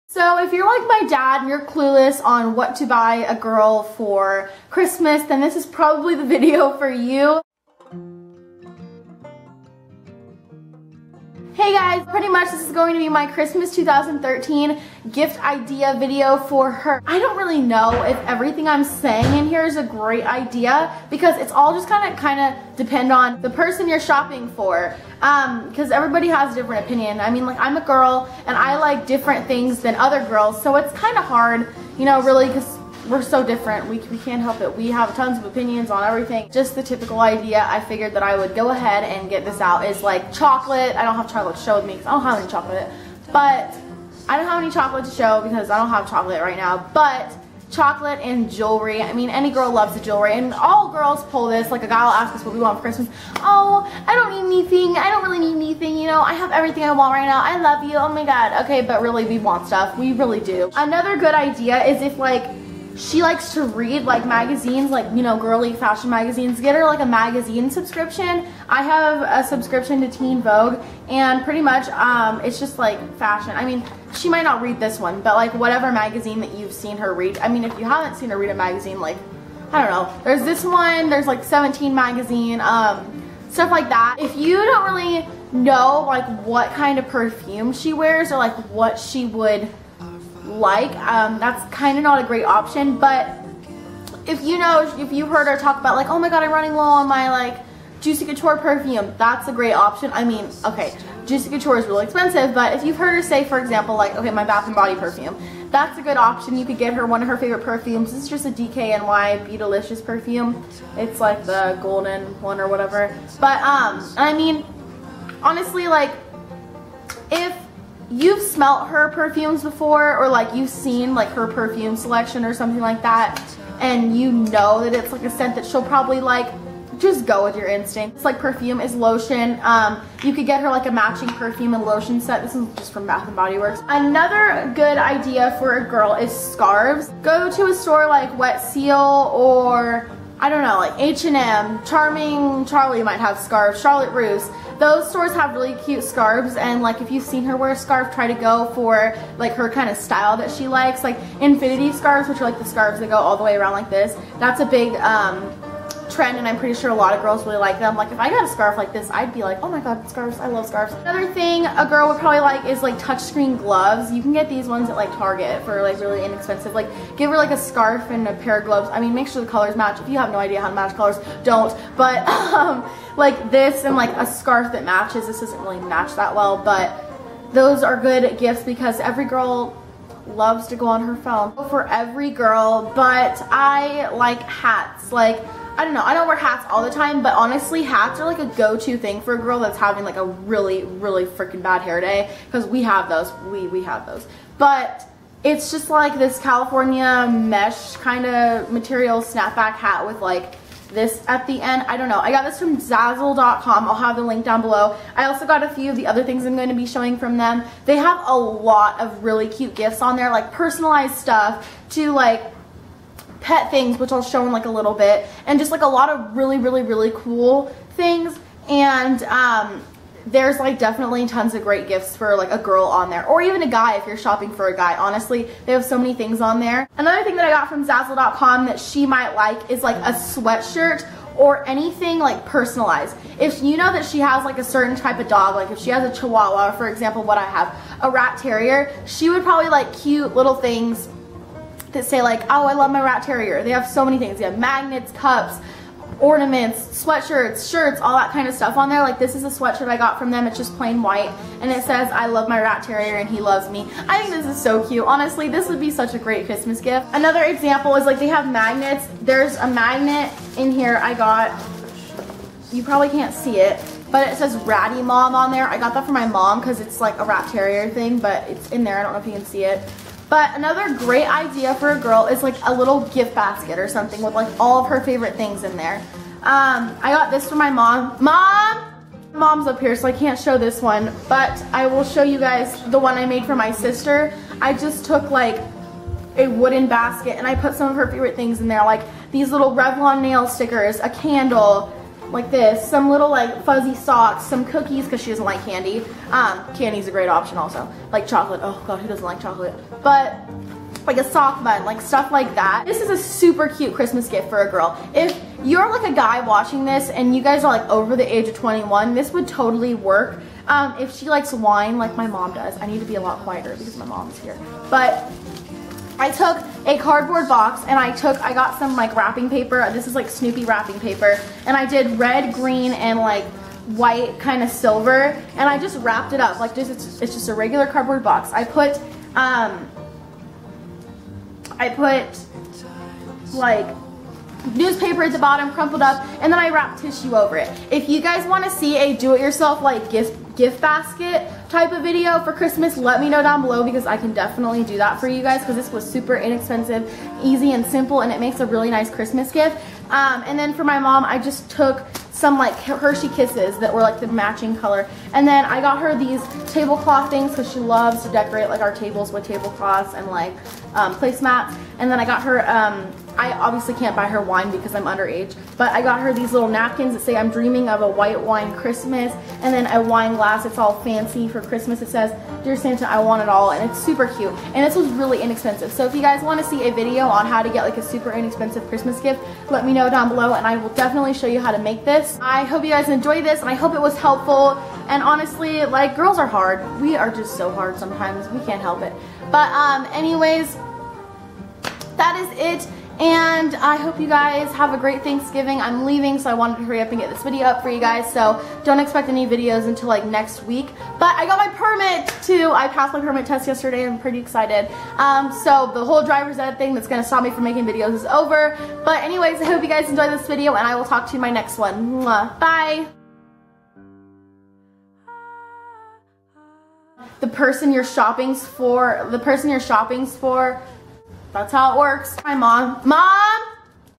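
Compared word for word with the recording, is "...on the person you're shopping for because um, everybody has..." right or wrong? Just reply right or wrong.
right.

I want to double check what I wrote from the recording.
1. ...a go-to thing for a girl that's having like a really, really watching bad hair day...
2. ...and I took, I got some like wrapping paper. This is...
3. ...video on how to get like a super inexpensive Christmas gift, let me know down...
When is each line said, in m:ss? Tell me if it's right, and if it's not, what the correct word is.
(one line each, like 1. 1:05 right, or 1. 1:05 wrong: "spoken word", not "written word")
1. 3:08 wrong: "freaking", not "watching"
2. 5:17 right
3. 6:16 right.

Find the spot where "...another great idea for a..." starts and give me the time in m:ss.
4:30.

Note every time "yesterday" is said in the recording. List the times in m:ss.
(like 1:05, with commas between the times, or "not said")
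6:43.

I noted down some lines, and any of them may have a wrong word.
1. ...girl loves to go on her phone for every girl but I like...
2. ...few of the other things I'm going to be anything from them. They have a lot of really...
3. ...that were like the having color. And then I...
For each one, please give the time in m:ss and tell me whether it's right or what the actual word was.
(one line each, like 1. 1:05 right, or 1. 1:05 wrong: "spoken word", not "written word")
1. 2:59 right
2. 3:25 wrong: "showing", not "anything"
3. 5:53 wrong: "matching", not "having".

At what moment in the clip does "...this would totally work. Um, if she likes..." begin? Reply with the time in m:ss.
5:09.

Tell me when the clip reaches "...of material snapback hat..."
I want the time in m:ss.
3:18.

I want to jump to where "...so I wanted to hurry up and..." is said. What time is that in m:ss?
6:36.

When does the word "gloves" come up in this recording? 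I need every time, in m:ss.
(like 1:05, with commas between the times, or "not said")
2:43, 2:48.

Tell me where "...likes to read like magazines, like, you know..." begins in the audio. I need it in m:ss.
1:03.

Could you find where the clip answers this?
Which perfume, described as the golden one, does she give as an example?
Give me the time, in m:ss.
1:48.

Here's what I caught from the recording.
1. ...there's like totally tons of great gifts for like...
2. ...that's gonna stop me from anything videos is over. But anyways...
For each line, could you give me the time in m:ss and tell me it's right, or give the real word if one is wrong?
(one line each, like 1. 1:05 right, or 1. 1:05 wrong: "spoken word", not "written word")
1. 3:40 wrong: "definitely", not "totally"
2. 6:46 wrong: "making", not "anything".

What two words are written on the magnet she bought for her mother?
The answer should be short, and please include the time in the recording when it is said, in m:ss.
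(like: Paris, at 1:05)
Ratty Mom, at 4:24.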